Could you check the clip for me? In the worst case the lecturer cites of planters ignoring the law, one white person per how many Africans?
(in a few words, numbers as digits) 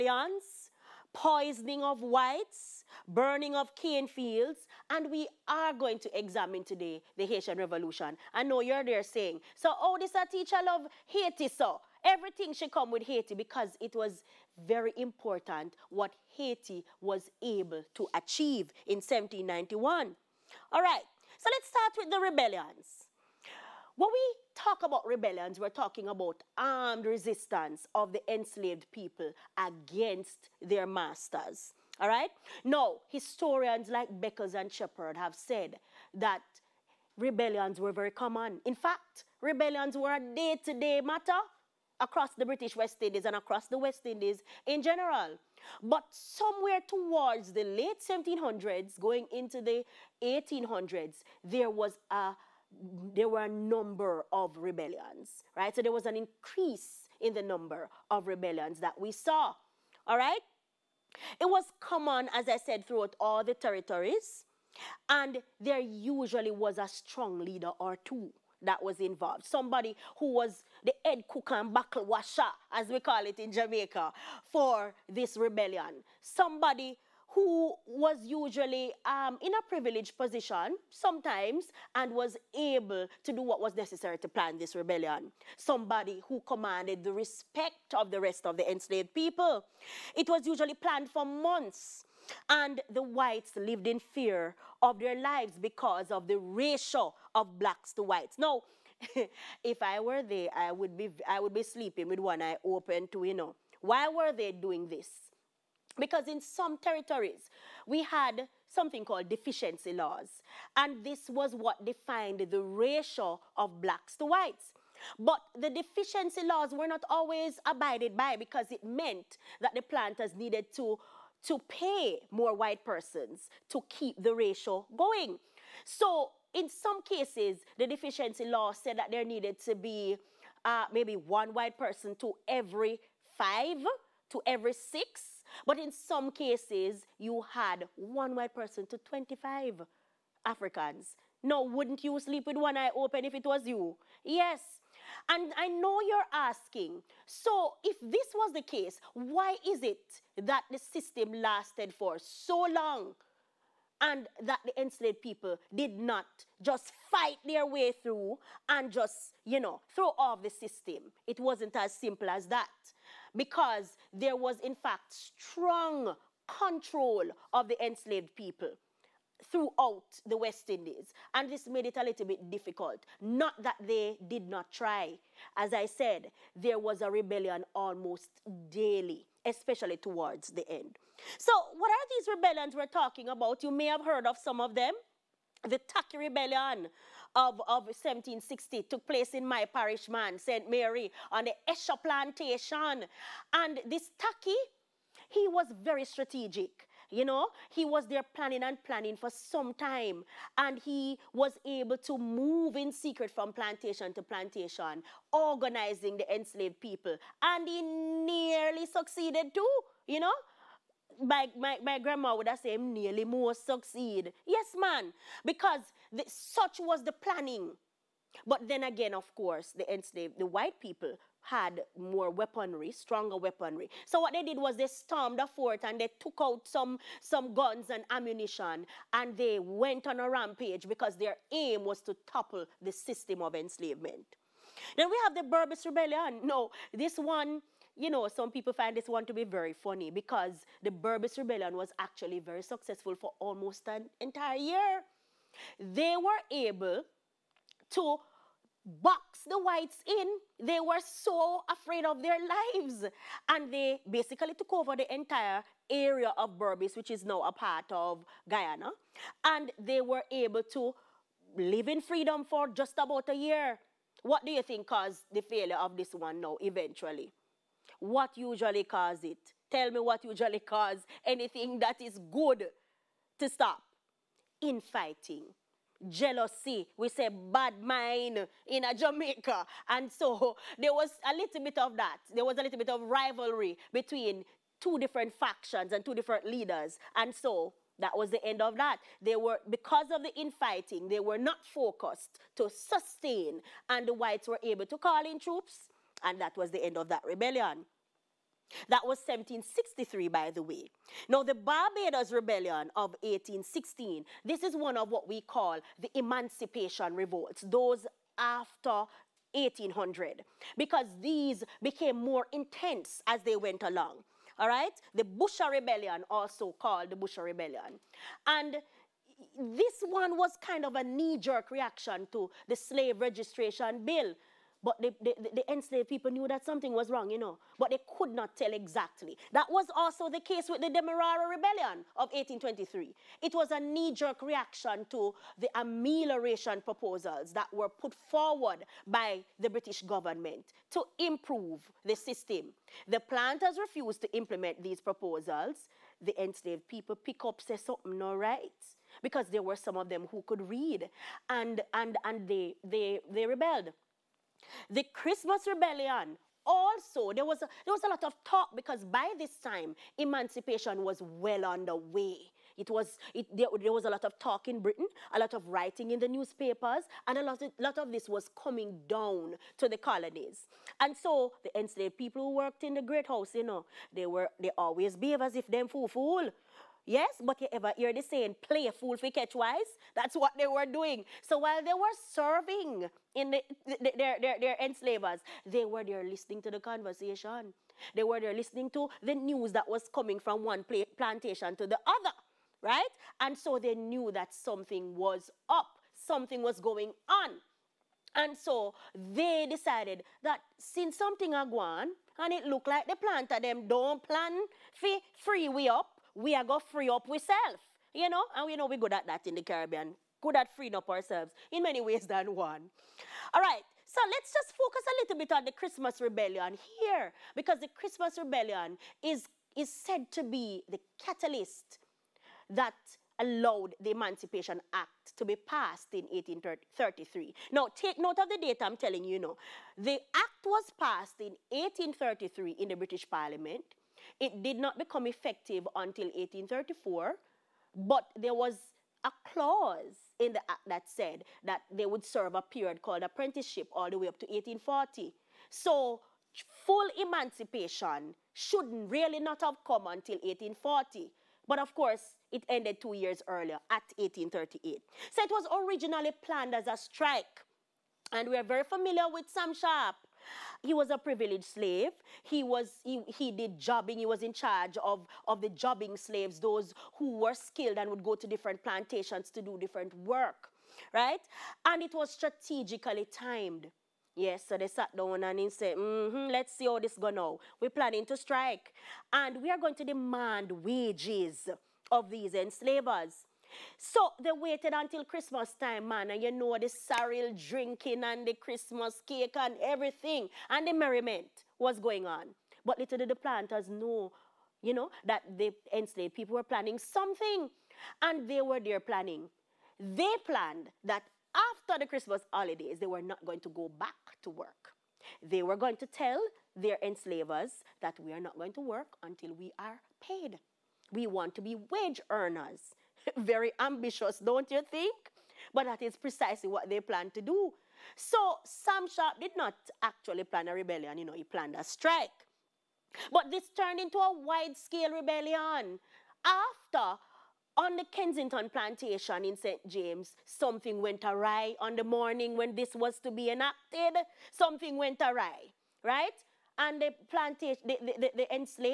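25.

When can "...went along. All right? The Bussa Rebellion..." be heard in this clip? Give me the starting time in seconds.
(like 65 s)
313 s.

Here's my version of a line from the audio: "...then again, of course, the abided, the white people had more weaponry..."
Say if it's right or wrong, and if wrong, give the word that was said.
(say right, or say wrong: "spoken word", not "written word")
wrong: "enslaved", not "abided".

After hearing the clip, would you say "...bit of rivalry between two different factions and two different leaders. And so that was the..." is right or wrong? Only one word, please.
right.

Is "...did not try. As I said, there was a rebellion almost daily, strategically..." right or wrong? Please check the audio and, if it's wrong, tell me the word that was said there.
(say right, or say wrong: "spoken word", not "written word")
wrong: "especially", not "strategically".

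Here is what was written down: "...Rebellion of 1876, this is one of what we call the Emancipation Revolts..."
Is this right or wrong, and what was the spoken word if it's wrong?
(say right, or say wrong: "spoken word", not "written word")
wrong: "1816", not "1876".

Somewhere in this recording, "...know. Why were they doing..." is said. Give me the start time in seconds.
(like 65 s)
103 s.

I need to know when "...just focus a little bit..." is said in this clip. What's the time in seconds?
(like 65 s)
414 s.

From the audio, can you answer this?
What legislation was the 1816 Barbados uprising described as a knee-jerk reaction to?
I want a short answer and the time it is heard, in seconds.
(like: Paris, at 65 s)
Slave registration bill, at 322 s.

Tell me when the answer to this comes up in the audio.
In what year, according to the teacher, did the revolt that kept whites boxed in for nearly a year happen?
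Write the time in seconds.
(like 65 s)
299 s.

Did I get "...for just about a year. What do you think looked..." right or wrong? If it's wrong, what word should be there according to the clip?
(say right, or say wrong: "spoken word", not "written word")
wrong: "caused", not "looked".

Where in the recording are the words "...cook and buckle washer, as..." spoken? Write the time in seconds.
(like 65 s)
71 s.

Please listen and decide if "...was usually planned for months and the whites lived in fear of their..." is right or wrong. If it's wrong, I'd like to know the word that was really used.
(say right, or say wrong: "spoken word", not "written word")
right.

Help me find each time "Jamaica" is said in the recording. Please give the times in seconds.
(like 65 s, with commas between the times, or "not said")
73 s, 278 s.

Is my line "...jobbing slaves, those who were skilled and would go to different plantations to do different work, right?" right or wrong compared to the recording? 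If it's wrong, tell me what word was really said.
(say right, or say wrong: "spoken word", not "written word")
right.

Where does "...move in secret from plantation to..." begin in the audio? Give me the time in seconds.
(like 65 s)
202 s.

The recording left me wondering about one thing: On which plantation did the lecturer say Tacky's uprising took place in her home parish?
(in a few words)
Esher Plantation.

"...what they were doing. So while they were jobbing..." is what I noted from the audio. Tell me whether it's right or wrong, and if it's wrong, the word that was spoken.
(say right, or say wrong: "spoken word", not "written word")
wrong: "serving", not "jobbing".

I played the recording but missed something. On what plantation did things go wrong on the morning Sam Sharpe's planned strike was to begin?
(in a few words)
Kensington plantation.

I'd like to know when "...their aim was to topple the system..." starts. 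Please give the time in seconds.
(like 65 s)
231 s.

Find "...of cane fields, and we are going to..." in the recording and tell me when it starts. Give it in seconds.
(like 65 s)
3 s.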